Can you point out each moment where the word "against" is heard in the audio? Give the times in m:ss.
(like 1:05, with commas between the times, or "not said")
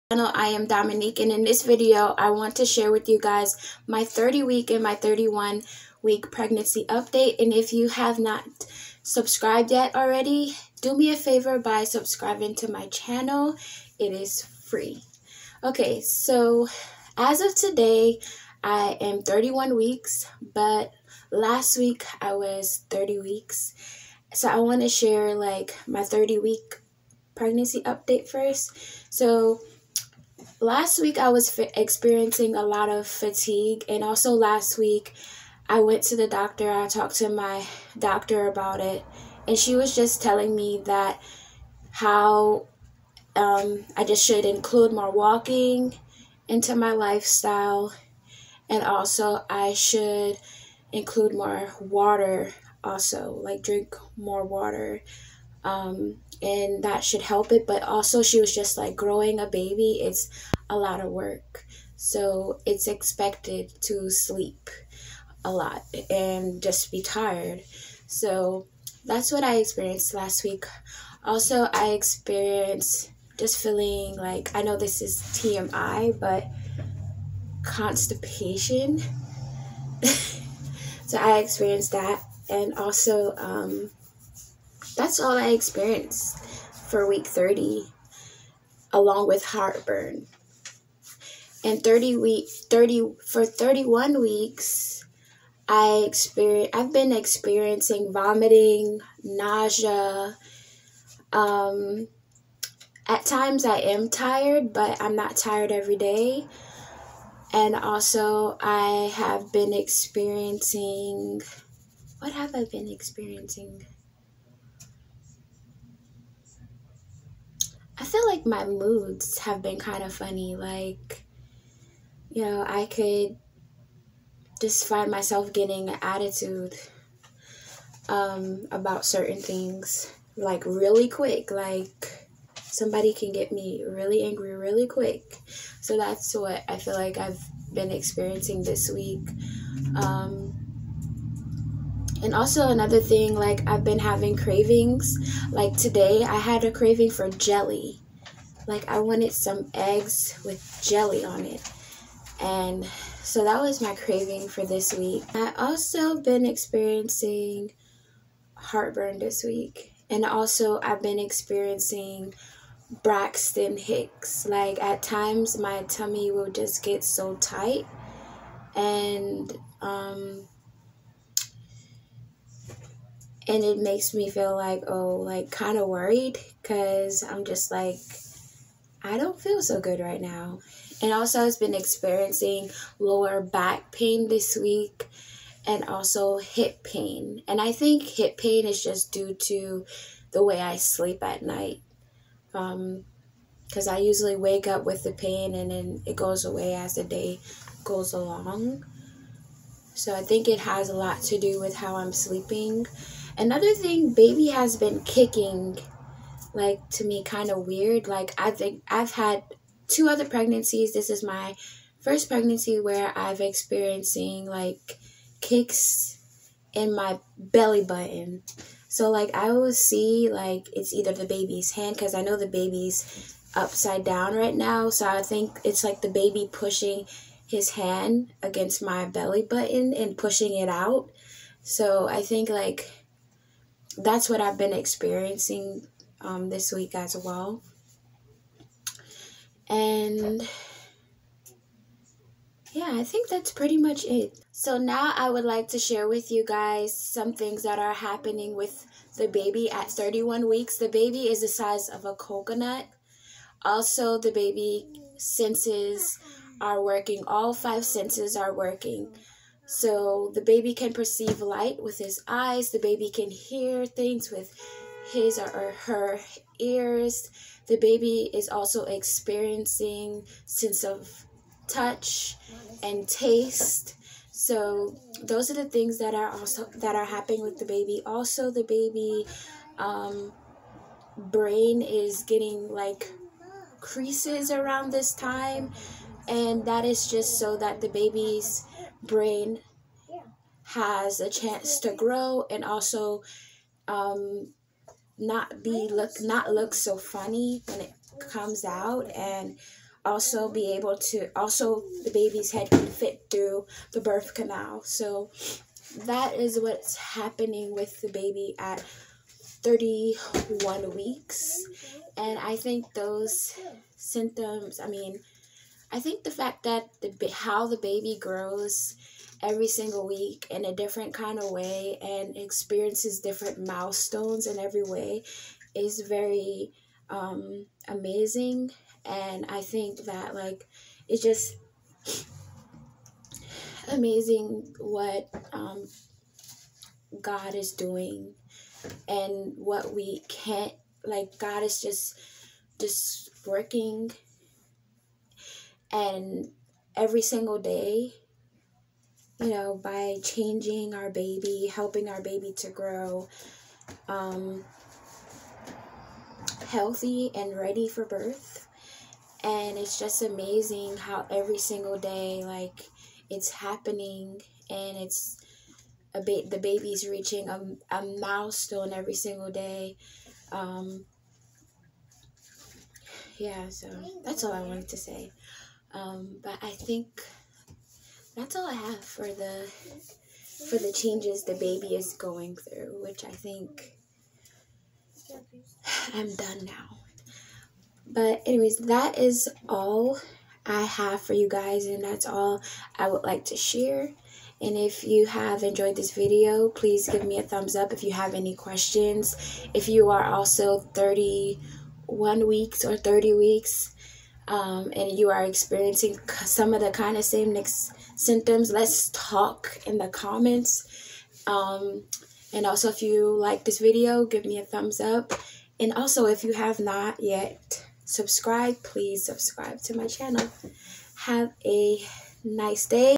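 3:48.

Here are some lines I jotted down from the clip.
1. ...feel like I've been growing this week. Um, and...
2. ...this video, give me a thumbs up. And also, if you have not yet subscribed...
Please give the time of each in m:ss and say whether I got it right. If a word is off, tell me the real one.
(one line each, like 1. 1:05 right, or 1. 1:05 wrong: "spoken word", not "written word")
1. 2:16 wrong: "experiencing", not "growing"
2. 6:53 right.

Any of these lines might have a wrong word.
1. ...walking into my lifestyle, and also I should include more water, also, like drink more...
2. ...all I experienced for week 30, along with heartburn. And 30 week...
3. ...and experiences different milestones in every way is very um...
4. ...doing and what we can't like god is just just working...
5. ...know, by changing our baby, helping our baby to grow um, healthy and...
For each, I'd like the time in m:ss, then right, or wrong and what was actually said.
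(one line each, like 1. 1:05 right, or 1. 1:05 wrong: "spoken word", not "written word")
1. 0:45 right
2. 1:25 right
3. 5:22 right
4. 5:37 right
5. 5:49 right.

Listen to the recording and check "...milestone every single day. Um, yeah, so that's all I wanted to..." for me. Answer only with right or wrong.
right.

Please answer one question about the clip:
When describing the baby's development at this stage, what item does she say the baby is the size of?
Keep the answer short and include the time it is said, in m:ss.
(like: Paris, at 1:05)
A coconut, at 4:12.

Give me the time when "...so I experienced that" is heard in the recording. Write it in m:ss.
1:21.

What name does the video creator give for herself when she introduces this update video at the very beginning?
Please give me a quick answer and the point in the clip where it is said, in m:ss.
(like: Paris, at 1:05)
Dominique, at 0:00.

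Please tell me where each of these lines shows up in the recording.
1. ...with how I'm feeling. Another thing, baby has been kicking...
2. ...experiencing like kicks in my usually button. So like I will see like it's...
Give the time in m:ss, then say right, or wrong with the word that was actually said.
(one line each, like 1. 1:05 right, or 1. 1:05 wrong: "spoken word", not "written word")
1. 3:21 wrong: "sleeping", not "feeling"
2. 3:33 wrong: "belly", not "usually".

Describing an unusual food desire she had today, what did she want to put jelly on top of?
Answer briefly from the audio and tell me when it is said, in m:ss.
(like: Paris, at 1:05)
Eggs, at 2:29.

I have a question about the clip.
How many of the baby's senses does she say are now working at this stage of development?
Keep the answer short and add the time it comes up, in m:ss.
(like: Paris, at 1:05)
5, at 4:17.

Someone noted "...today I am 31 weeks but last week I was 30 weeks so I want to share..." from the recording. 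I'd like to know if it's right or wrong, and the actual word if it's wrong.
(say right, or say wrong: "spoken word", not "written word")
right.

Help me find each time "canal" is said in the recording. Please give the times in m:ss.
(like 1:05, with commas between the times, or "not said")
5:04.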